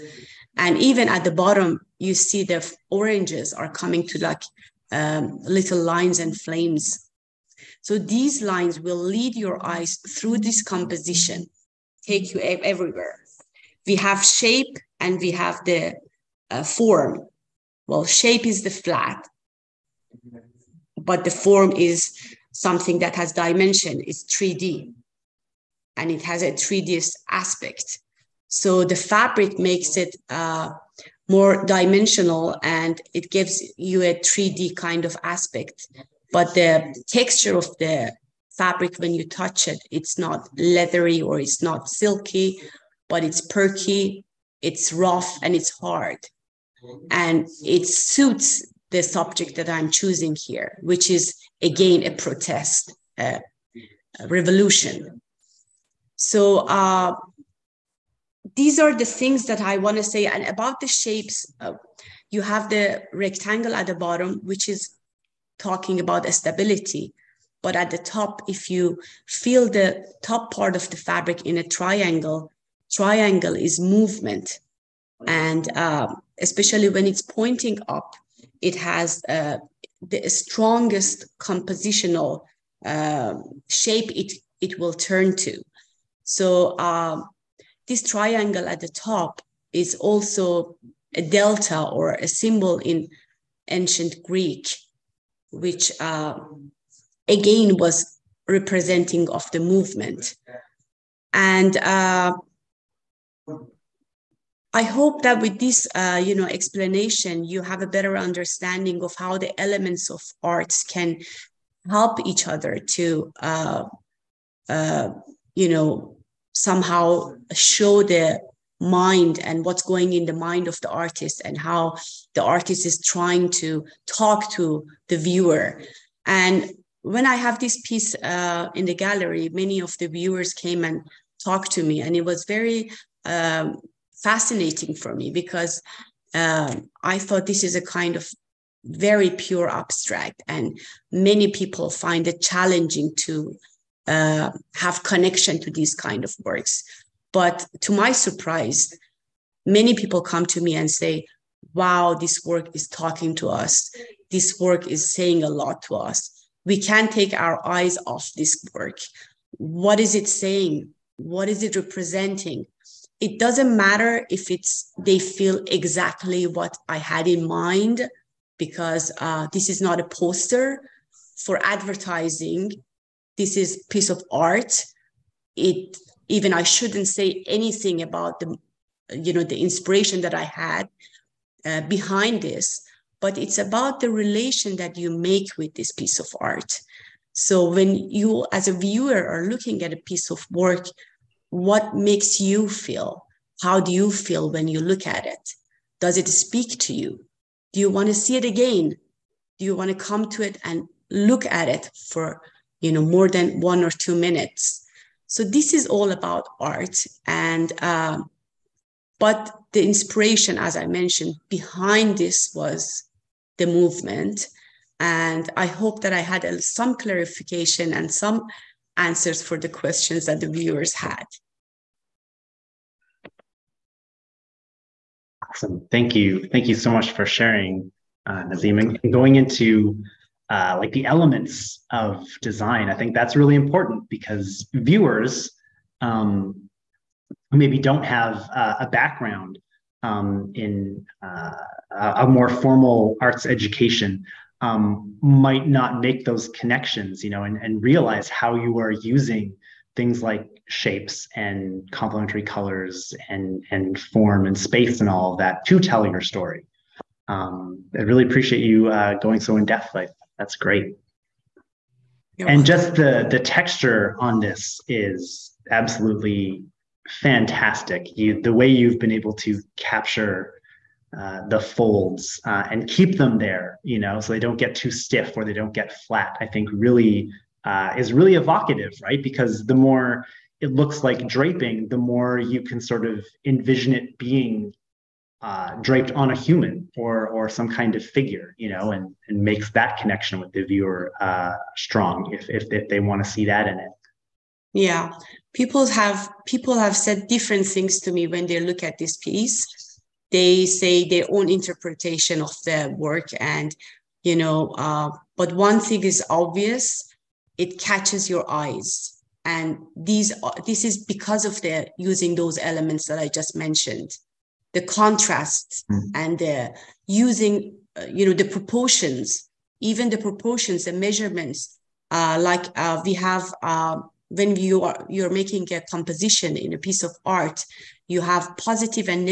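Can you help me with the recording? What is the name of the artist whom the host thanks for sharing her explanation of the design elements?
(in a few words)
Nasim.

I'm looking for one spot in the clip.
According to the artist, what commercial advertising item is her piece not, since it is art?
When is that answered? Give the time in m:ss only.
2:50.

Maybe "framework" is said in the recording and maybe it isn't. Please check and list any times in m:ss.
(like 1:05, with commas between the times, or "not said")
not said.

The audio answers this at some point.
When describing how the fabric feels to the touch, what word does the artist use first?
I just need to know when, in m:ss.
0:43.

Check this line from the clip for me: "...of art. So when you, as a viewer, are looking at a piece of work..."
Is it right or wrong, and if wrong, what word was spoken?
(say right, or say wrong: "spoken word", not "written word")
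right.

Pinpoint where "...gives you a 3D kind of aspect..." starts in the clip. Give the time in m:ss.
0:33.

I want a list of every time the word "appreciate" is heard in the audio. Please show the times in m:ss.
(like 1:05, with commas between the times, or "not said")
4:18.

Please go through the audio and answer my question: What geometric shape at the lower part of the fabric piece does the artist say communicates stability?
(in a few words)
rectangle.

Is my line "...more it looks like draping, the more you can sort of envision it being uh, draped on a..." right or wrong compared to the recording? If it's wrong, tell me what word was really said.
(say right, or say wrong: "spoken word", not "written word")
right.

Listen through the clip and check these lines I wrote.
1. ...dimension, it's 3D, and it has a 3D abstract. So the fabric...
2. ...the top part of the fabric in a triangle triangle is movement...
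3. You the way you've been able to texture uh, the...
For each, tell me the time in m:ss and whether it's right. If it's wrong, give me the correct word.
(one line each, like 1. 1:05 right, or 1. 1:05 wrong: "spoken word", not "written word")
1. 0:23 wrong: "aspect", not "abstract"
2. 1:09 right
3. 4:28 wrong: "capture", not "texture".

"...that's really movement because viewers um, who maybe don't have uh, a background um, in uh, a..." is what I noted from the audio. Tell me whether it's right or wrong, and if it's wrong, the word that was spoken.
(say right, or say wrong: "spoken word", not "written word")
wrong: "important", not "movement".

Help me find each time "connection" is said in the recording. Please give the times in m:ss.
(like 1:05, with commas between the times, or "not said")
2:25, 4:06, 4:50.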